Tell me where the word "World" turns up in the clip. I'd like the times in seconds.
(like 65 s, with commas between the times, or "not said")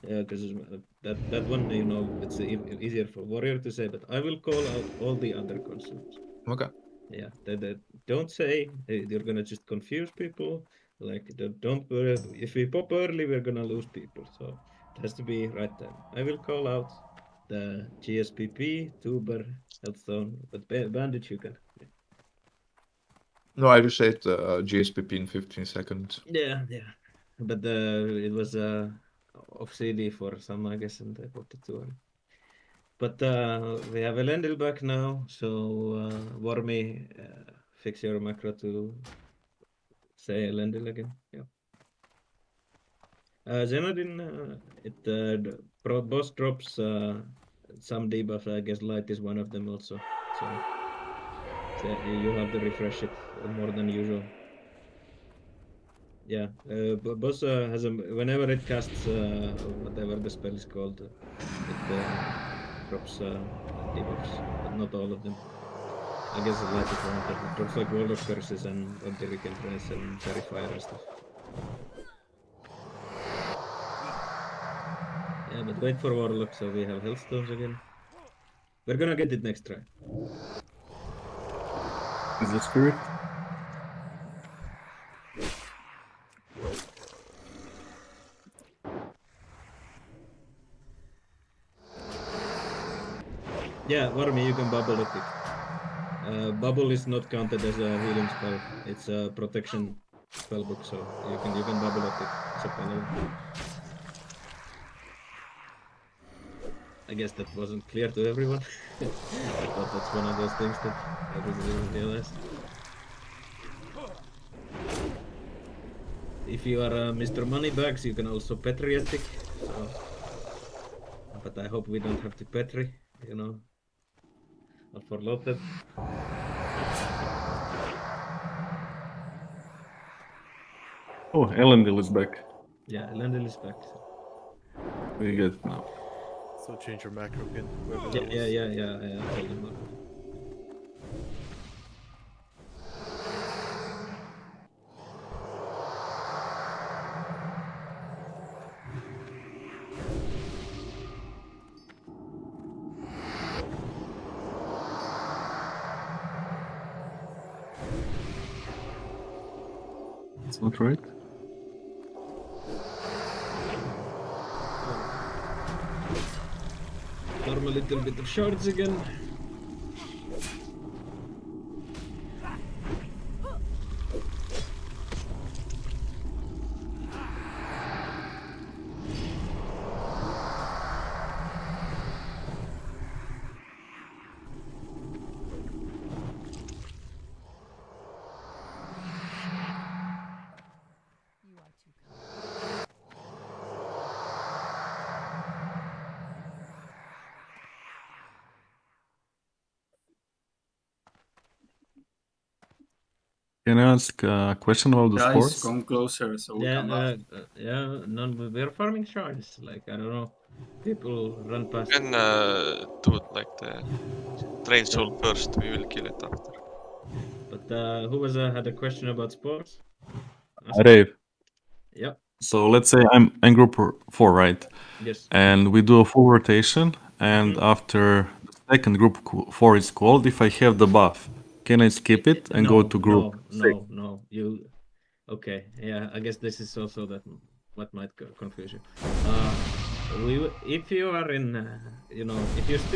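67 s.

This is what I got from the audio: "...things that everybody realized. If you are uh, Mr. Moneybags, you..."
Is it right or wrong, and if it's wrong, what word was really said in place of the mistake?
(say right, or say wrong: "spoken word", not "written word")
right.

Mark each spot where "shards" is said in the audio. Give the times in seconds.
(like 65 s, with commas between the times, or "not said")
168 s, 209 s.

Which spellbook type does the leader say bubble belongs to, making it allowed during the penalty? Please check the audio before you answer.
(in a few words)
protection.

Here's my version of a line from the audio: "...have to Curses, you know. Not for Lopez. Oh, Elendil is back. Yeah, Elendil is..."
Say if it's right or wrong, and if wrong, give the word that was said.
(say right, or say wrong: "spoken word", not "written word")
wrong: "Petri", not "Curses".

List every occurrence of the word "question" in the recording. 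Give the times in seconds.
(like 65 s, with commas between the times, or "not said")
204 s, 218 s.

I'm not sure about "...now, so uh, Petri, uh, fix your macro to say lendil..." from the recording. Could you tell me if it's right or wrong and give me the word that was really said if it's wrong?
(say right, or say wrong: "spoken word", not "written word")
wrong: "Wormy", not "Petri".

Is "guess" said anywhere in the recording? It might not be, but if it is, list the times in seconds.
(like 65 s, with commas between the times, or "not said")
30 s, 48 s, 66 s, 107 s, 236 s.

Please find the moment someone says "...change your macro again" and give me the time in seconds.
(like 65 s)
136 s.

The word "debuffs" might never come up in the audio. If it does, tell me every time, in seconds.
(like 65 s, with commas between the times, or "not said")
48 s, 63 s.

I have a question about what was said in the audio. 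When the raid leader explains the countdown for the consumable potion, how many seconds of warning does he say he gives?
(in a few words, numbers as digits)
15.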